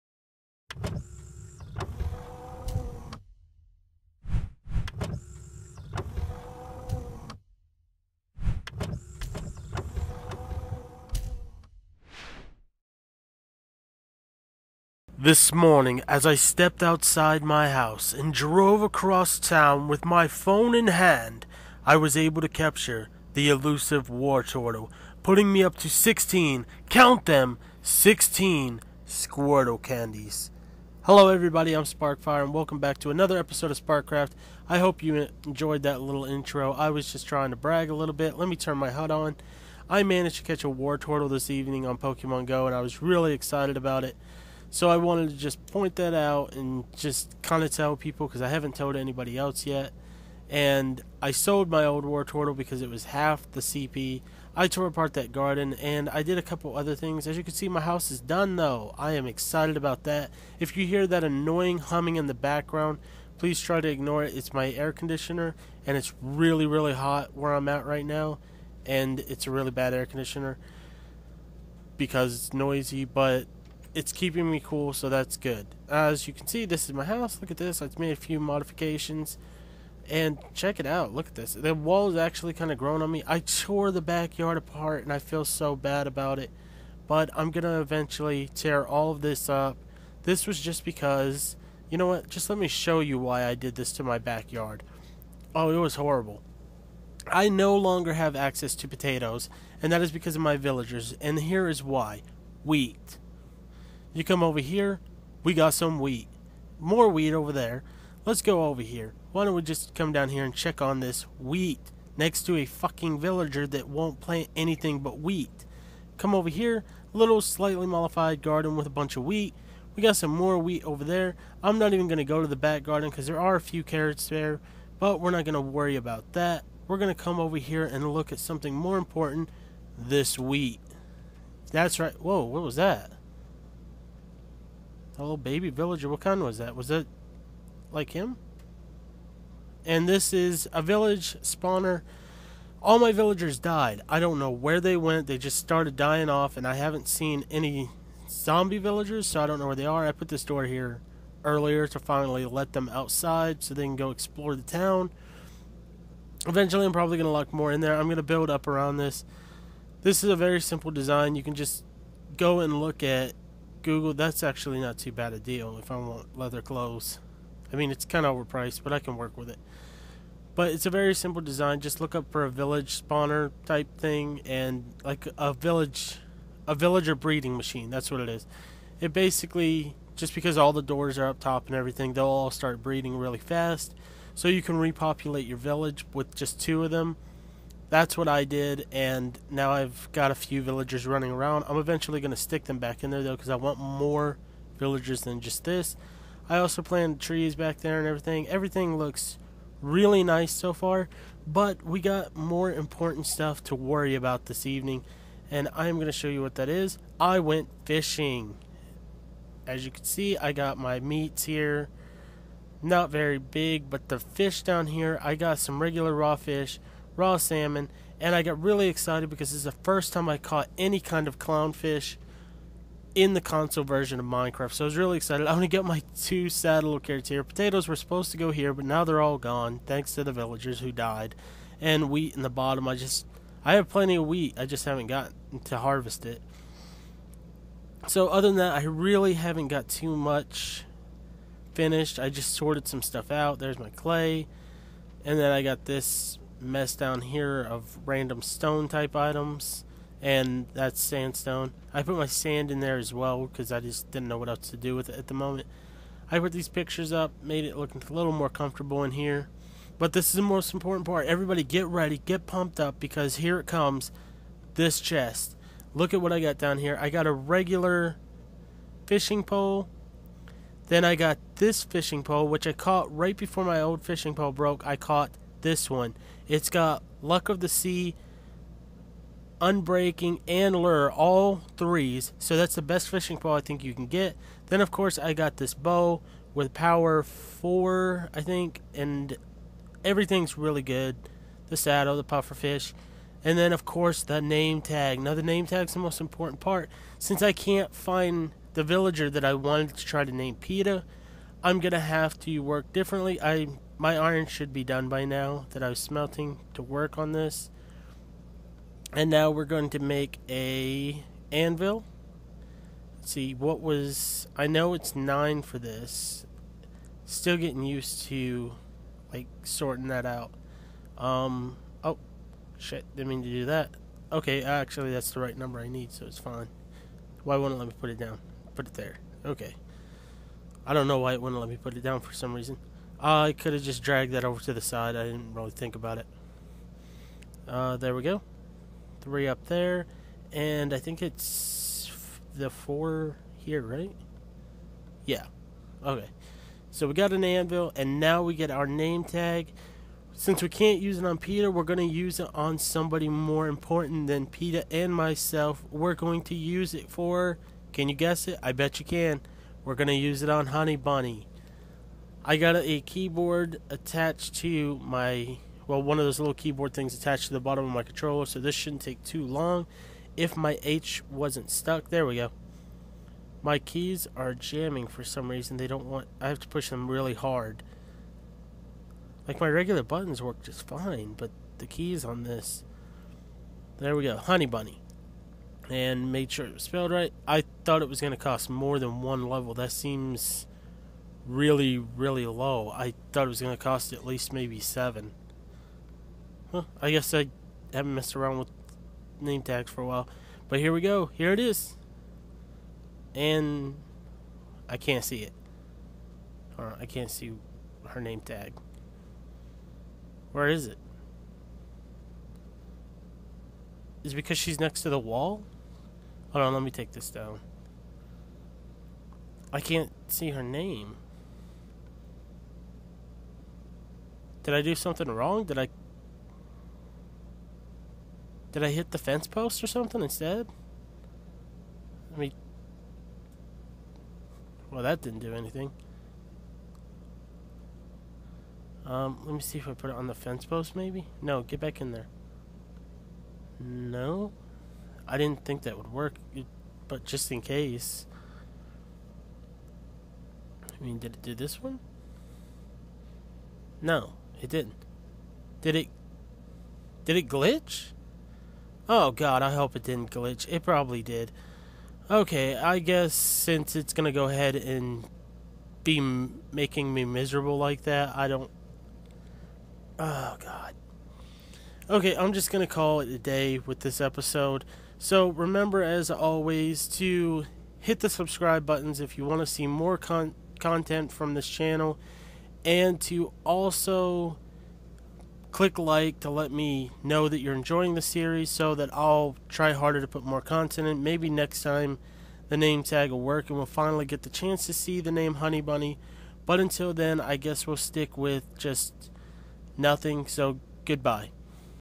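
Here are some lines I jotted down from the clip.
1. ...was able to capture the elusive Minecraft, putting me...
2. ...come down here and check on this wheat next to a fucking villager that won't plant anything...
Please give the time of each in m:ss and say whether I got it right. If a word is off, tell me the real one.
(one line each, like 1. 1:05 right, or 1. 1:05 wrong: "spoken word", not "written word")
1. 0:21 wrong: "Wartortle", not "Minecraft"
2. 1:49 right.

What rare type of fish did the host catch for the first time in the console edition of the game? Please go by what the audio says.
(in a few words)
clownfish.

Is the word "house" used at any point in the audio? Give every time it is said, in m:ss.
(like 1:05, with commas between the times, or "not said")
0:17, 0:57, 1:17.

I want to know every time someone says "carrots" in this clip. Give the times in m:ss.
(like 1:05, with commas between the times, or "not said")
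2:03, 3:46.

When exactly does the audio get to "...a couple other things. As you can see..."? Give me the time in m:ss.
0:56.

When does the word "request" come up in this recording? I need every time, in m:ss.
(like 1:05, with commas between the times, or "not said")
not said.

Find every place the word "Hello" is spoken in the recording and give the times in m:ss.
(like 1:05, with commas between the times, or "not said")
0:31.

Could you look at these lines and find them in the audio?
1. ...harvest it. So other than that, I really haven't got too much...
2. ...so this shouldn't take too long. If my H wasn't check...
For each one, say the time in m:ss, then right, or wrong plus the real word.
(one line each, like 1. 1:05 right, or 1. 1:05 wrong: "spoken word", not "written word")
1. 3:55 right
2. 6:08 wrong: "stuck", not "check".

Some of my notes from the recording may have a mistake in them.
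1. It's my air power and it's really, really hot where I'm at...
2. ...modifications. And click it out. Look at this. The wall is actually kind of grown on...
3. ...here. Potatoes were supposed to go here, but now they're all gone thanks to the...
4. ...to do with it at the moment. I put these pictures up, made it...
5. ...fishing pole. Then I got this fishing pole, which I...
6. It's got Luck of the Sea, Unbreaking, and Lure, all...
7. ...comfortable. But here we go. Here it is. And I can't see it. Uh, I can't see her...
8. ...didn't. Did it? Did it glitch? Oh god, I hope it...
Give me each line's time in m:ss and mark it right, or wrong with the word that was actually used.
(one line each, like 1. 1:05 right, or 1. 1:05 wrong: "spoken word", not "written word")
1. 1:04 wrong: "conditioner", not "power"
2. 1:18 wrong: "check", not "click"
3. 3:47 right
4. 4:14 right
5. 4:29 right
6. 4:36 right
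7. 6:40 wrong: "while", not "comfortable"
8. 7:34 right.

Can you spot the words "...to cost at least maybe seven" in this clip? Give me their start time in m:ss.
6:33.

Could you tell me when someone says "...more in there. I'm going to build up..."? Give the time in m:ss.
2:37.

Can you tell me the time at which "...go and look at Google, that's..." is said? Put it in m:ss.
2:42.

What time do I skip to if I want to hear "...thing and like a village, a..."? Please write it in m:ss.
2:53.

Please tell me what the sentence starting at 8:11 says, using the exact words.
Maybe next time the name tag will work and we'll finally get the chance to see the name Honey Bunny.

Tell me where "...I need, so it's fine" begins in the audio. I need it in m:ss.
5:25.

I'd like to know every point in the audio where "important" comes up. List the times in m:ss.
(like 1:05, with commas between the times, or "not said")
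2:08, 3:22, 4:20, 4:56, 5:53.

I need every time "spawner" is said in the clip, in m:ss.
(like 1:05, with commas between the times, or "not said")
2:21, 2:53.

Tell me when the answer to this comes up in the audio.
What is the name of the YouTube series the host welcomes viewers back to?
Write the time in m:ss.
0:33.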